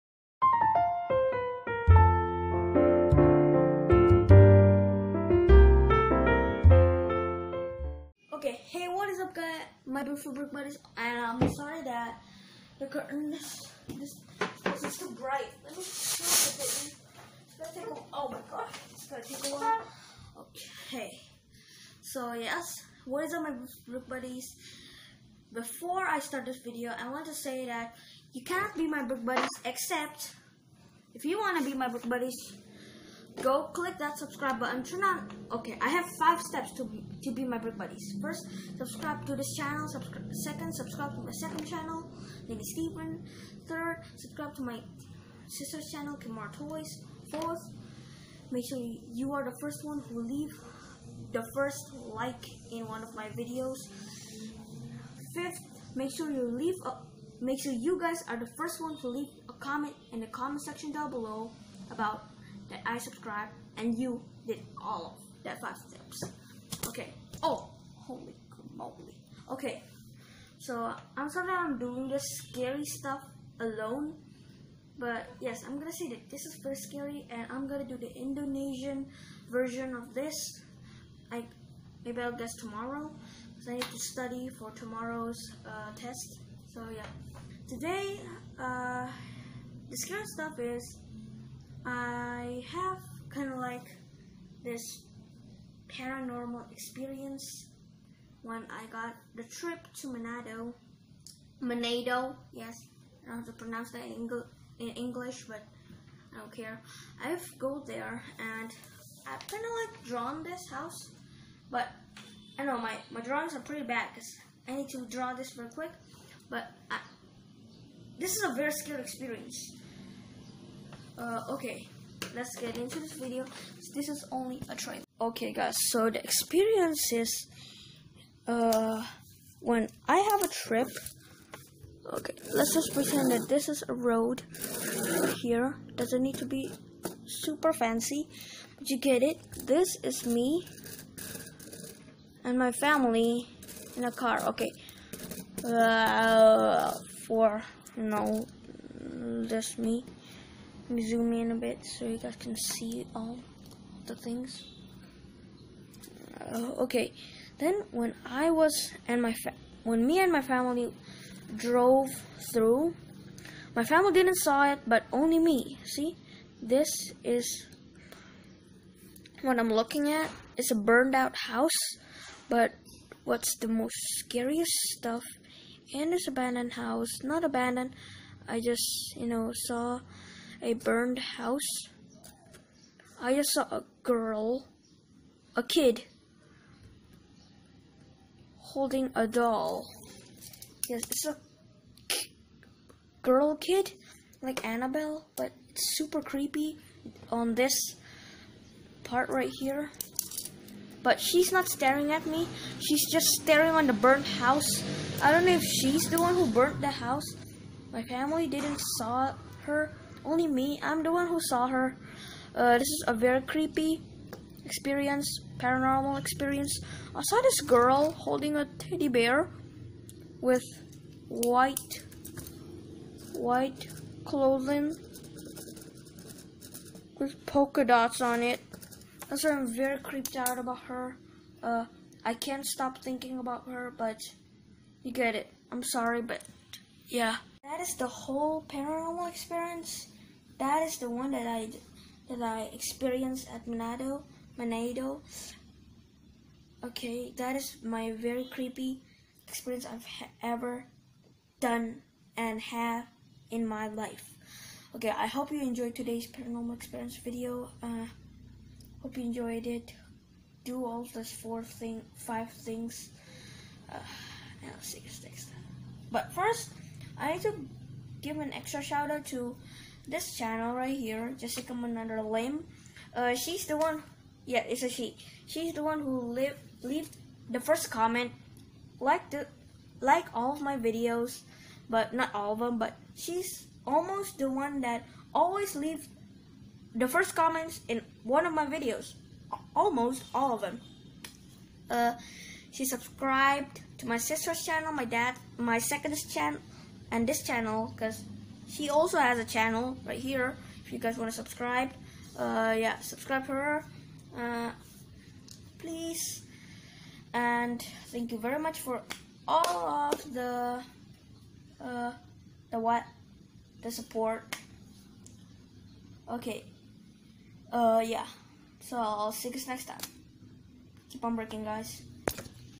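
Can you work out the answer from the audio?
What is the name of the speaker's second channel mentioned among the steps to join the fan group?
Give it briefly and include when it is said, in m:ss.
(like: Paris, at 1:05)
Lady Steven, at 0:42.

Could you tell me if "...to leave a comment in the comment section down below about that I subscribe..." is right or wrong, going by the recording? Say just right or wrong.
right.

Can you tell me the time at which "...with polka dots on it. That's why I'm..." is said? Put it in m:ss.
3:47.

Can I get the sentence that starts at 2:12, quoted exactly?
Okay, let's just pretend that this is a road here.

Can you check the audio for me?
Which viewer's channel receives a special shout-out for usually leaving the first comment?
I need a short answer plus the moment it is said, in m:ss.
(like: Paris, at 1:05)
Jessica Manandra Lim, at 4:31.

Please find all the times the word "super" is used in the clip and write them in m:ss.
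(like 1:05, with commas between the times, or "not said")
2:17, 3:15.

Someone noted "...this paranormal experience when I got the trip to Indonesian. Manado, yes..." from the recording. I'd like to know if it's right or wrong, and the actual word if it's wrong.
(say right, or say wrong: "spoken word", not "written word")
wrong: "Manado", not "Indonesian".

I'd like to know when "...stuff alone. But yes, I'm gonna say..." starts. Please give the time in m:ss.
1:12.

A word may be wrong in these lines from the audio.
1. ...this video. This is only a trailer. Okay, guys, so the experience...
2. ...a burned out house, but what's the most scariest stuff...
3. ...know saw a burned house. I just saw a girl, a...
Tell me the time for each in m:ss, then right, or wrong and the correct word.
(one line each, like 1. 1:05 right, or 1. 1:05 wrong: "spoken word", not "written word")
1. 2:02 right
2. 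2:50 right
3. 2:59 right.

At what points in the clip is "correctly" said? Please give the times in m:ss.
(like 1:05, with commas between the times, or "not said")
not said.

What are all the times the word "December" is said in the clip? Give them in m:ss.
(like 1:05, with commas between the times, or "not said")
not said.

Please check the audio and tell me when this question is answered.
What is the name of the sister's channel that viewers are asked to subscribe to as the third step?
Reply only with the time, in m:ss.
0:46.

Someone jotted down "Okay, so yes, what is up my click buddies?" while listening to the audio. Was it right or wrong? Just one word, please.
wrong.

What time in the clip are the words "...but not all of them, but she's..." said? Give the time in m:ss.
4:41.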